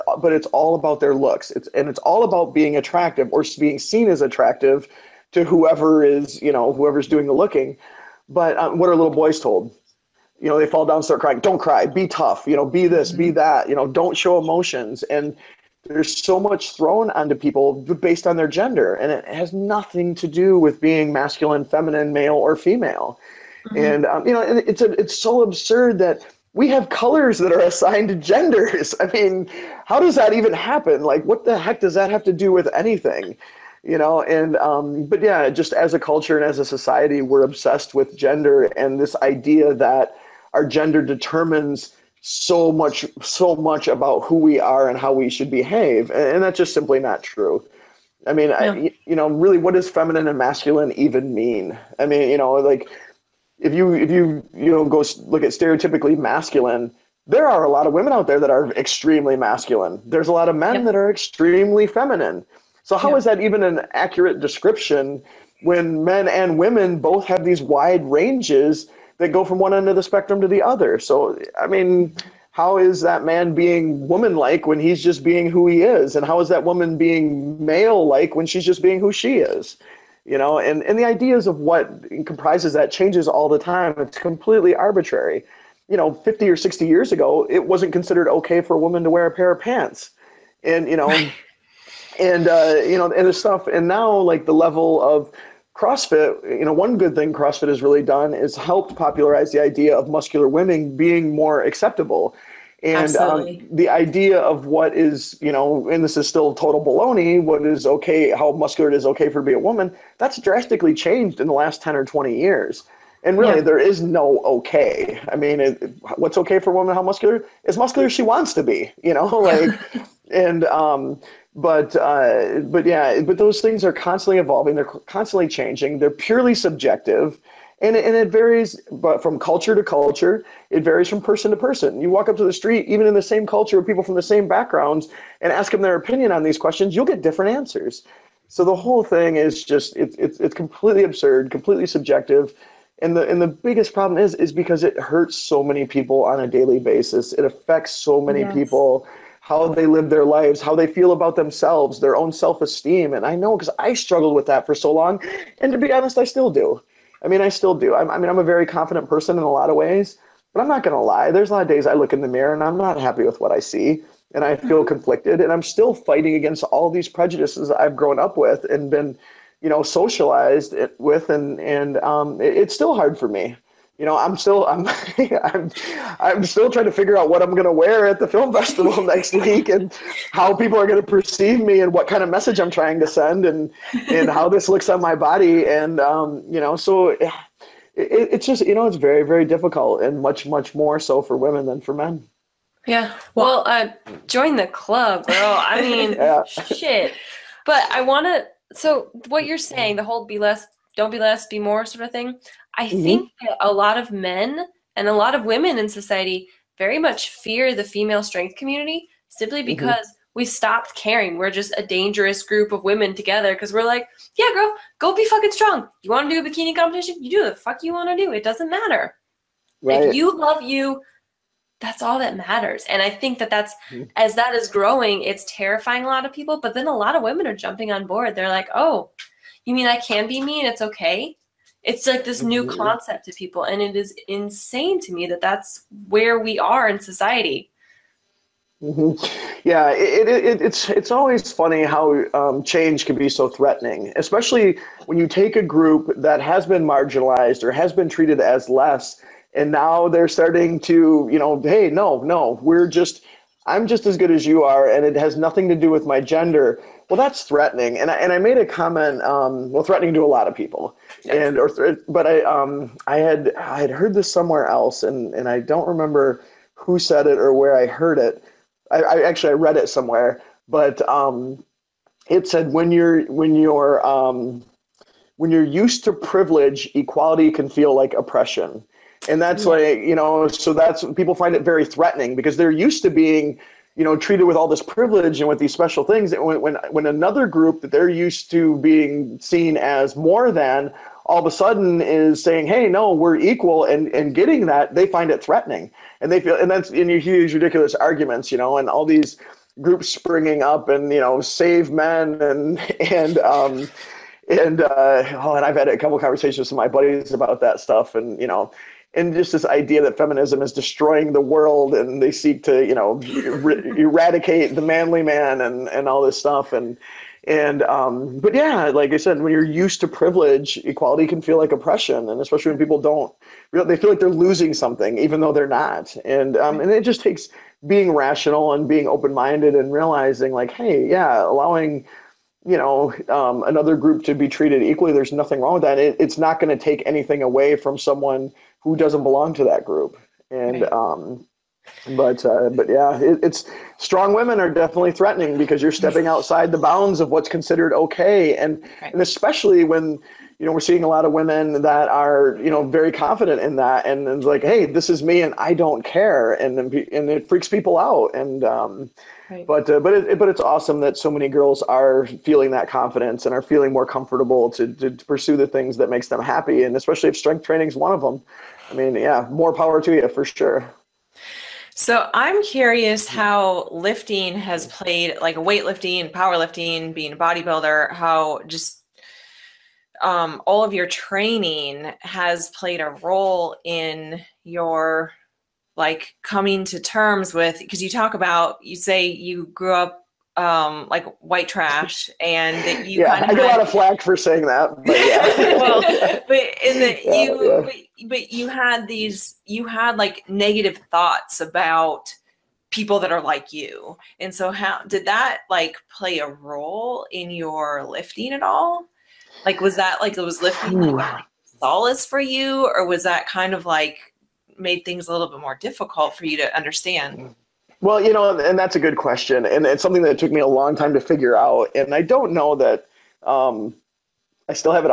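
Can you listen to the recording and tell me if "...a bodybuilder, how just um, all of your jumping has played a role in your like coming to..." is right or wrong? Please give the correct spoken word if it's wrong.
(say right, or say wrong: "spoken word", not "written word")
wrong: "training", not "jumping".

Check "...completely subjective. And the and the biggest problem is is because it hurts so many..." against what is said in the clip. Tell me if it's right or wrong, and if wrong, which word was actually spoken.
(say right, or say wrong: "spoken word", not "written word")
right.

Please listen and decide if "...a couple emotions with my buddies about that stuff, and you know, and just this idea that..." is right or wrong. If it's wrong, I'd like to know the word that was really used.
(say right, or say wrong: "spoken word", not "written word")
wrong: "conversations", not "emotions".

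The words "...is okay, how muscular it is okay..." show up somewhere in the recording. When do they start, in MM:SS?
01:47.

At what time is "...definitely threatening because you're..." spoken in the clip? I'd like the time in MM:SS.
05:44.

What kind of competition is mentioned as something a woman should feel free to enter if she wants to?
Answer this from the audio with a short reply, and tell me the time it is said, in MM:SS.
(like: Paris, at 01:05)
Bikini competition, at 03:36.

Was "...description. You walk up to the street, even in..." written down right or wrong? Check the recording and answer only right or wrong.
wrong.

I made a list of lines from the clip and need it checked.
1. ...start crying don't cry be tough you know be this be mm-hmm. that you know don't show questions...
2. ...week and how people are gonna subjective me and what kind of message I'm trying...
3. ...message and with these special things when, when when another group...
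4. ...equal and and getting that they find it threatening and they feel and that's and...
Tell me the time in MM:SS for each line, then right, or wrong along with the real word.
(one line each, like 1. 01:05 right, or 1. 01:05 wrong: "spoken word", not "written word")
1. 00:11 wrong: "emotions", not "questions"
2. 02:59 wrong: "perceive", not "subjective"
3. 04:44 wrong: "privilege", not "message"
4. 04:53 right.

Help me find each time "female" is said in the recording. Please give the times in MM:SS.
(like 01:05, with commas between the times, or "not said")
00:22, 03:27.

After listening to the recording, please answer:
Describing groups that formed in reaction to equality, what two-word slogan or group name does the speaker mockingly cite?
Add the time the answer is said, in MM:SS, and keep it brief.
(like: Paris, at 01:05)
Save men, at 05:01.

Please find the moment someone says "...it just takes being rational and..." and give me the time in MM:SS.
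05:26.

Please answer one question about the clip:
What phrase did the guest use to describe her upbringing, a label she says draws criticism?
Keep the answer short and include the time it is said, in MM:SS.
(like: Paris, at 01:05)
White trash, at 06:31.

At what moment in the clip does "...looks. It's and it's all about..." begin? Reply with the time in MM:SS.
00:01.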